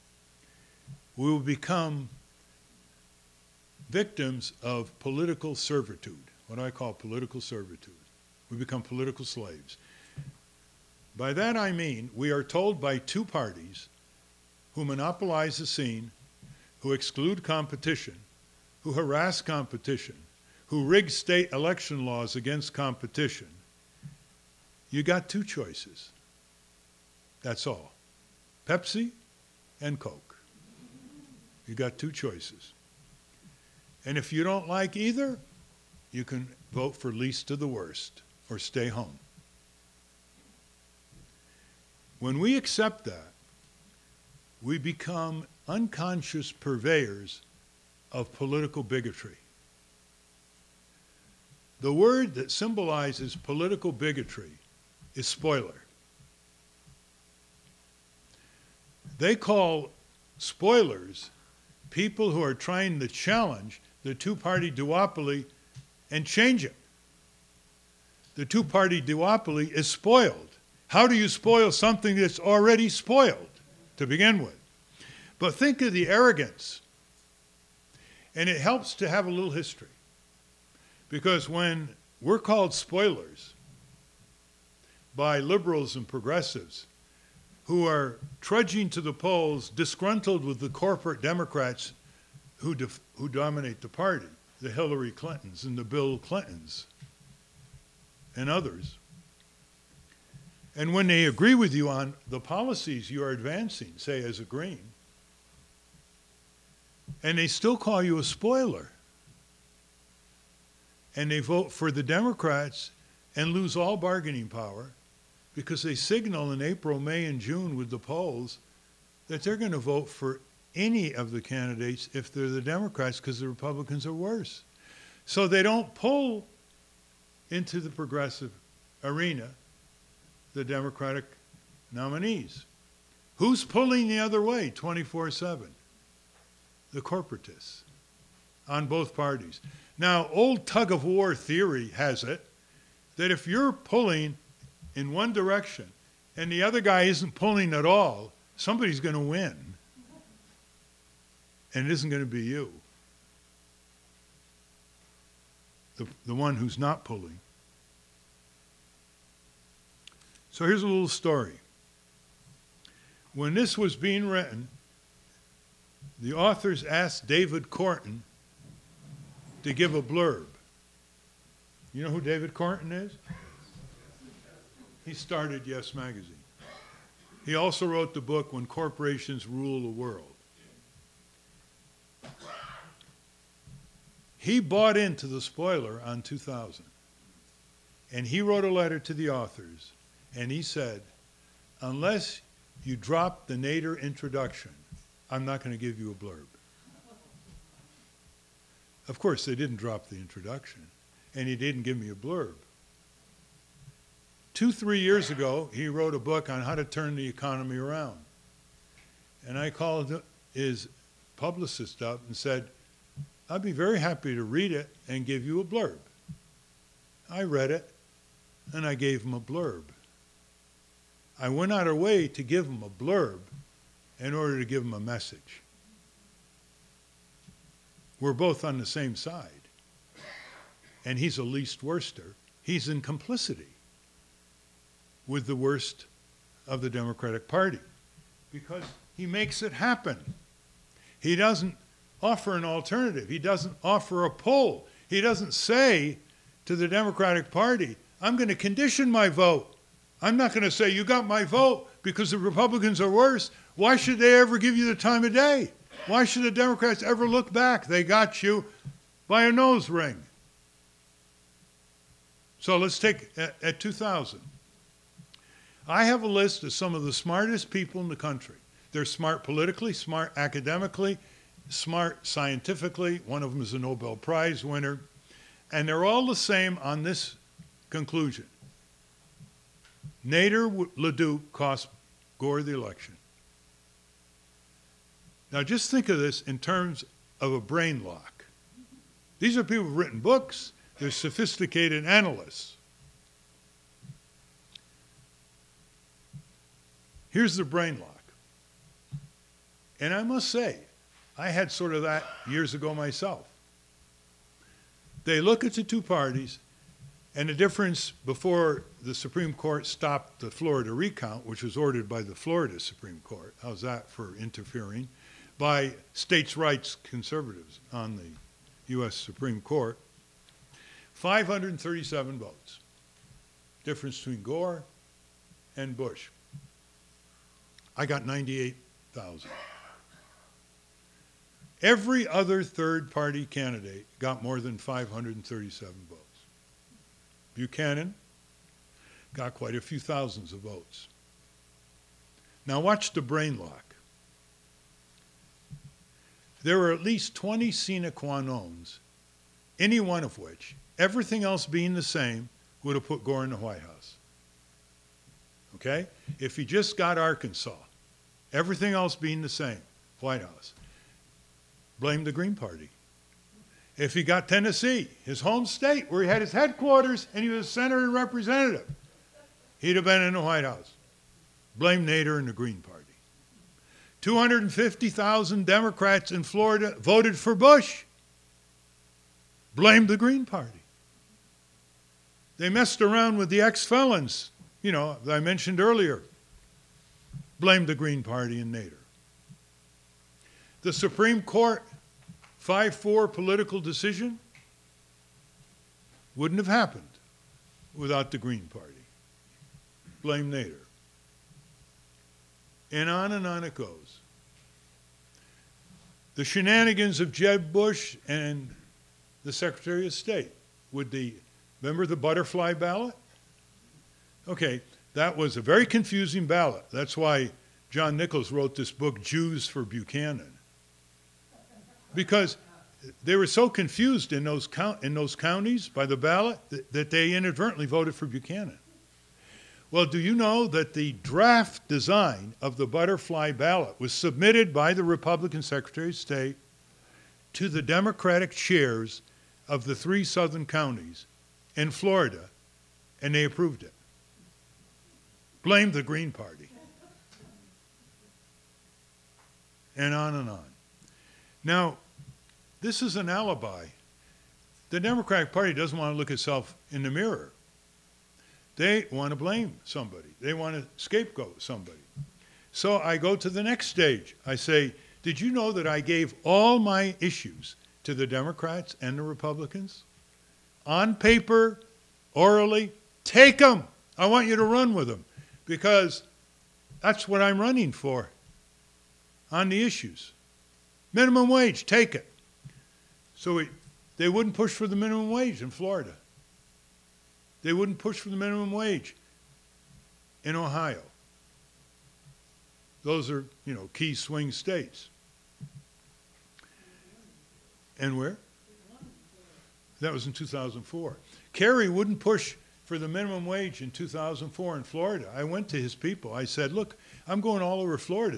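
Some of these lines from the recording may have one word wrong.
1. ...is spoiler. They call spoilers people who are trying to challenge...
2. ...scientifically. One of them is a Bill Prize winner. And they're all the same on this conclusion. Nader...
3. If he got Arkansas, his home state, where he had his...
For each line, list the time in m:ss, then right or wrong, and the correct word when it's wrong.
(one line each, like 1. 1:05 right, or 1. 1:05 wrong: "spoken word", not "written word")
1. 0:55 right
2. 4:32 wrong: "Nobel", not "Bill"
3. 6:03 wrong: "Tennessee", not "Arkansas".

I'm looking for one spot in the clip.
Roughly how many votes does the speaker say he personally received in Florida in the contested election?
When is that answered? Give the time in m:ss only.
5:28.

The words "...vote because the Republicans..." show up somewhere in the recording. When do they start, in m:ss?
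4:11.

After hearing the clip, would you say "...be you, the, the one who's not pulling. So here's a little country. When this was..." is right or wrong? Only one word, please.
wrong.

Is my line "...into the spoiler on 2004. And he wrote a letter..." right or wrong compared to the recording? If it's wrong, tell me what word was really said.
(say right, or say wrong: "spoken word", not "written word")
wrong: "2000", not "2004".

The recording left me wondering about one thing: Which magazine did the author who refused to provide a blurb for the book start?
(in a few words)
Yes Magazine.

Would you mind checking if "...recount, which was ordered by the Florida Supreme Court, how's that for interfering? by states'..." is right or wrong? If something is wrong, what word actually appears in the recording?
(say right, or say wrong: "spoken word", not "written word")
right.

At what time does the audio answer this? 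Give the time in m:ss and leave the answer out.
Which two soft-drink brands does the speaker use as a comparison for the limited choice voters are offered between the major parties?
0:28.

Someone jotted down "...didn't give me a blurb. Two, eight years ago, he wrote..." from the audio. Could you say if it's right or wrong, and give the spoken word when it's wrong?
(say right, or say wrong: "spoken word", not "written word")
wrong: "three", not "eight".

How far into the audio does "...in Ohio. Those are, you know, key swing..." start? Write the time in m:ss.
8:10.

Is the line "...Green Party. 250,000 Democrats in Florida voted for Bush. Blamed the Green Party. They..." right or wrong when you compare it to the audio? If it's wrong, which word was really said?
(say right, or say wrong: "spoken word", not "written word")
right.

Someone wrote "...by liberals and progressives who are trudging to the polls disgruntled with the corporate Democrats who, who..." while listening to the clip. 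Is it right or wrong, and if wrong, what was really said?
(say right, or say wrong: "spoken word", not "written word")
right.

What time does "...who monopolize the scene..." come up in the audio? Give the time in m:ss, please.
0:14.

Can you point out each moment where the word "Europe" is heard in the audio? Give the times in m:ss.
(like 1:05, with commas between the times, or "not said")
not said.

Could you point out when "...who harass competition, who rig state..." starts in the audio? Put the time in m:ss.
0:18.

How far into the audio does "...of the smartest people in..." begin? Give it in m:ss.
4:26.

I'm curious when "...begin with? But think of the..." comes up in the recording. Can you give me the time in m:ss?
1:14.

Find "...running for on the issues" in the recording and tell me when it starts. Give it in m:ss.
7:57.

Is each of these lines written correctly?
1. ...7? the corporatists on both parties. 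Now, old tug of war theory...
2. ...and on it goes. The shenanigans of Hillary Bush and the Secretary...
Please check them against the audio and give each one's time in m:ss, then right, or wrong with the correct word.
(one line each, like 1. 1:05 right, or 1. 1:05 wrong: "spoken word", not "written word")
1. 2:15 right
2. 6:43 wrong: "Jeb", not "Hillary".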